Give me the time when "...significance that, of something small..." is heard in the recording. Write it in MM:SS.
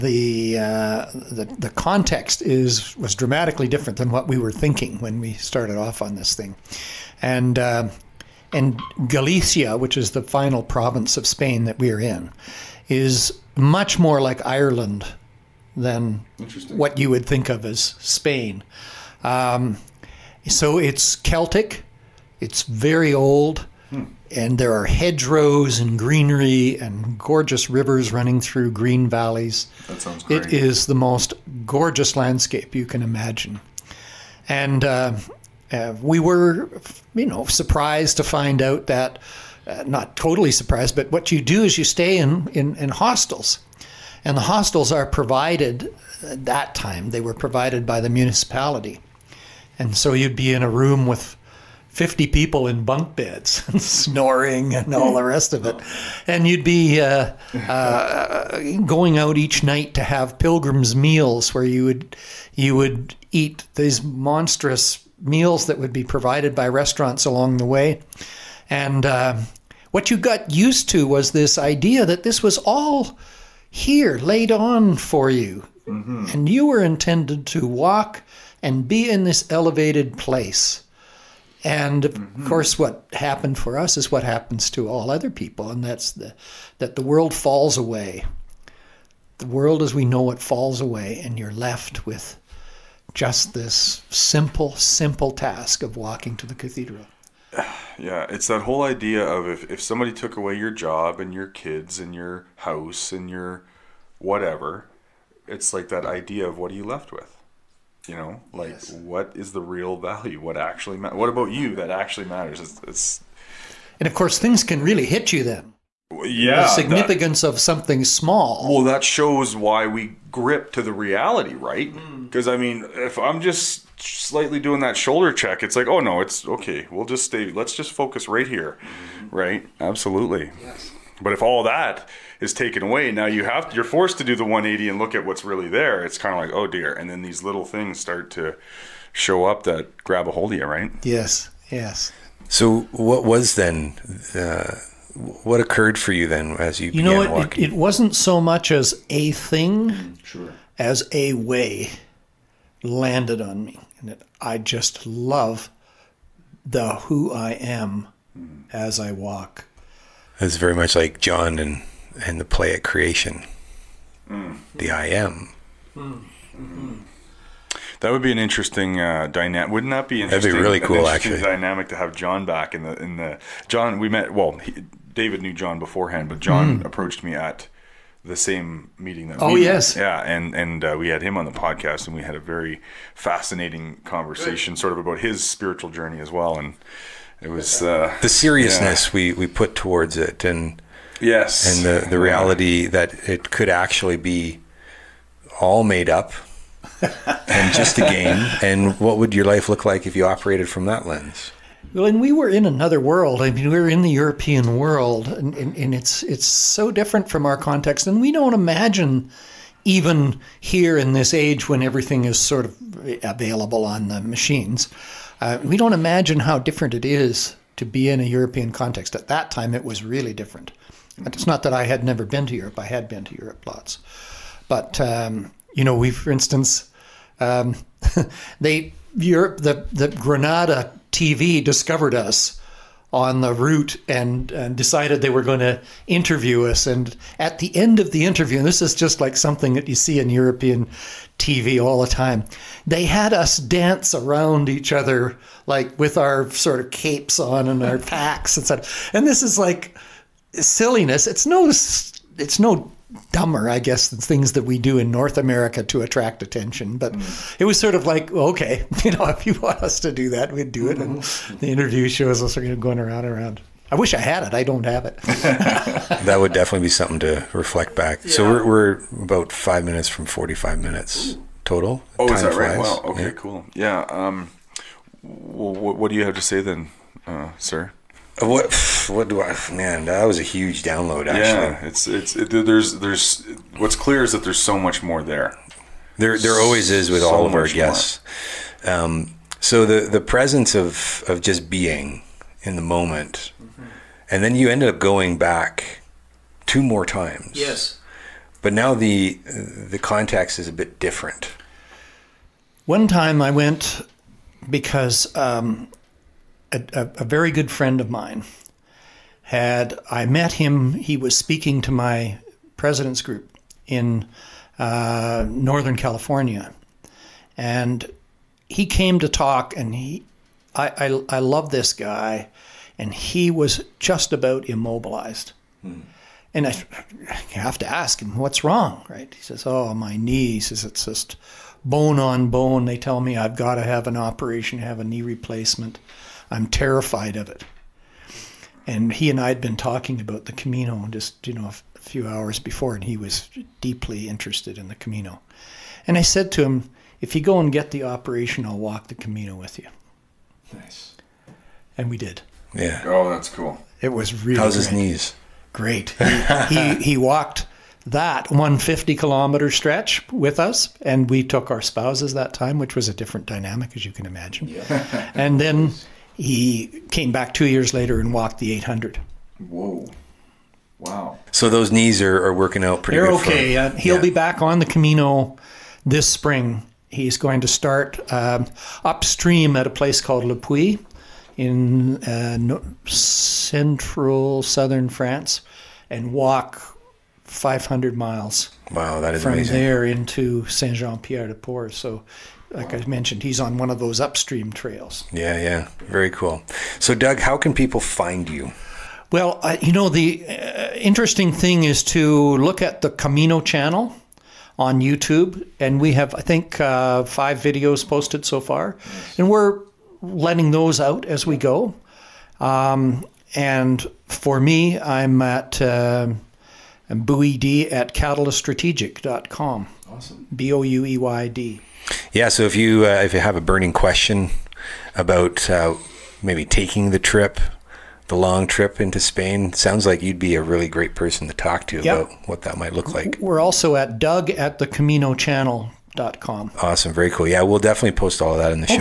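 01:56.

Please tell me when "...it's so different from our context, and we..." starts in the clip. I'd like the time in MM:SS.
03:26.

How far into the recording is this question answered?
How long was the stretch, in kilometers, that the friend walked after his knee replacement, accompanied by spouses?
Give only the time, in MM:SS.
05:58.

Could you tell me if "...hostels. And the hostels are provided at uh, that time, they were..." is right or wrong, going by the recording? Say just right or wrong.
right.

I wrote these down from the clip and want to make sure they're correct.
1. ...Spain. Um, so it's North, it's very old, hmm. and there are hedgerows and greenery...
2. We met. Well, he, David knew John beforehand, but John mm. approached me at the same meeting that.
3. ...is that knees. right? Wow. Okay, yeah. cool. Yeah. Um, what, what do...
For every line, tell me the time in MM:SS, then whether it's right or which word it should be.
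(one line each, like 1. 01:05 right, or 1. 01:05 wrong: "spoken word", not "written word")
1. 00:17 wrong: "Celtic", not "North"
2. 02:53 right
3. 04:32 wrong: "flies", not "knees".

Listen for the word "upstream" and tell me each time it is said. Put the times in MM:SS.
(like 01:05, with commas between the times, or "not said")
06:19, 06:34.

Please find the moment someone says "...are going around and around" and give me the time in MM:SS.
04:22.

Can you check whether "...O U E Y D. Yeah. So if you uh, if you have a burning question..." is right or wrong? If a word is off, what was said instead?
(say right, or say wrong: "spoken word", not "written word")
right.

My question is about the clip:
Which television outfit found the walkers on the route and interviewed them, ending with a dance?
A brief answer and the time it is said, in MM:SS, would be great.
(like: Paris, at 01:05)
Granada TV, at 03:50.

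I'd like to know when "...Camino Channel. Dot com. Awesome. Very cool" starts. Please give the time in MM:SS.
07:14.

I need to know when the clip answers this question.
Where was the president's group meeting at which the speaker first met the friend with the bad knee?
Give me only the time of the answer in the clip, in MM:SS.
05:15.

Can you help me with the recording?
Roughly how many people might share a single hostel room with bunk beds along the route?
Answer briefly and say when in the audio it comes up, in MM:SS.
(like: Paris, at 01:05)
50, at 00:51.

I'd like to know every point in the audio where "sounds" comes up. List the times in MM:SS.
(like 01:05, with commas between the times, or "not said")
00:30, 07:09.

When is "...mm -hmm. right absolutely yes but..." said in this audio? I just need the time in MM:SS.
02:08.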